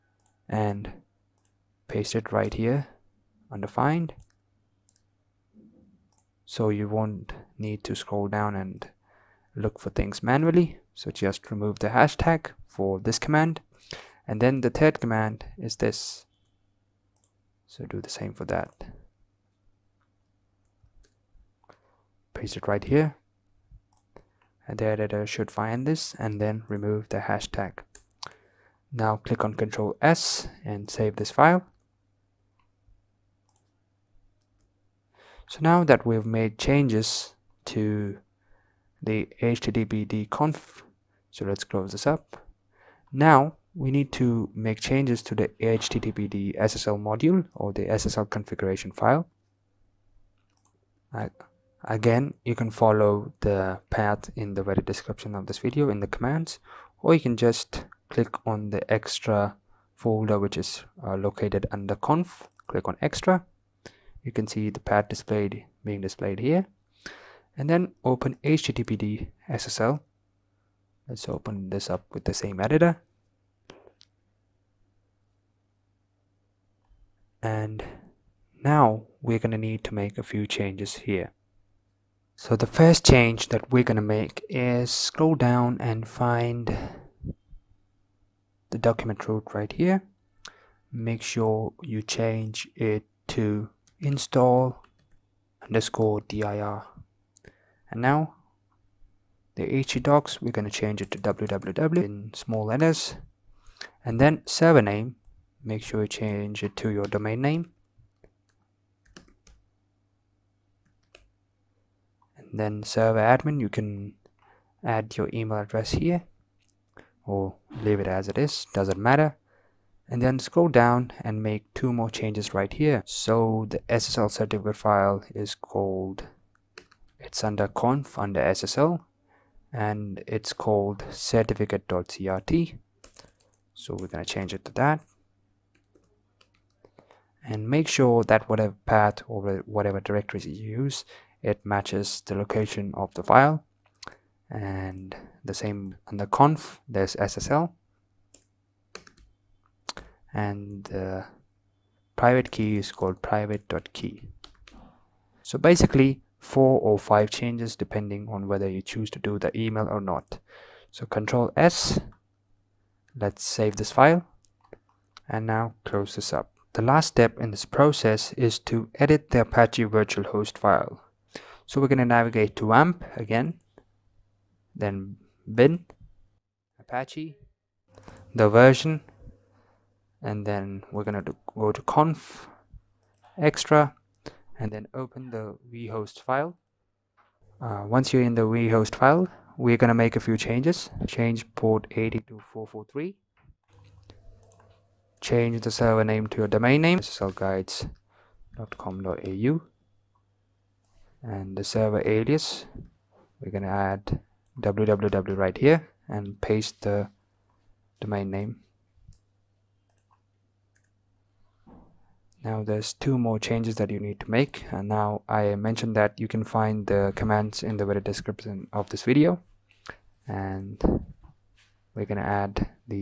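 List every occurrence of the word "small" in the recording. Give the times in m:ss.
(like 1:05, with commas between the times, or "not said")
1:42.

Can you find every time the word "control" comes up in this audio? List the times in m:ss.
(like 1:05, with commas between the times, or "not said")
0:29, 2:41.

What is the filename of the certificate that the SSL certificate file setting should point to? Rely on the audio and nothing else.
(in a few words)
certificate.crt.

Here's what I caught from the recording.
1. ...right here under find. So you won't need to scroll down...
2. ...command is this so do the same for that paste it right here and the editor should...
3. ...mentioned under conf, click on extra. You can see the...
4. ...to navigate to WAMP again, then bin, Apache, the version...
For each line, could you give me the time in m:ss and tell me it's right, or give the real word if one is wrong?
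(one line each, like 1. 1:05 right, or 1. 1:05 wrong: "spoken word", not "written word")
1. 0:02 right
2. 0:14 right
3. 1:01 wrong: "located", not "mentioned"
4. 2:51 right.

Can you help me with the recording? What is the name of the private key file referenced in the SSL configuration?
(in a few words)
private.key.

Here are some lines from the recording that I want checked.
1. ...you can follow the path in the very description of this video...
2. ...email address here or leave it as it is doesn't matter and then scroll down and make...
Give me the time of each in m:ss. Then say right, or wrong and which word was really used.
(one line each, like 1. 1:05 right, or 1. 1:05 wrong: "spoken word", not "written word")
1. 0:52 right
2. 1:55 right.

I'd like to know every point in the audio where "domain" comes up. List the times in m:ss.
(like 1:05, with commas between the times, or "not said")
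1:47, 3:16, 3:28.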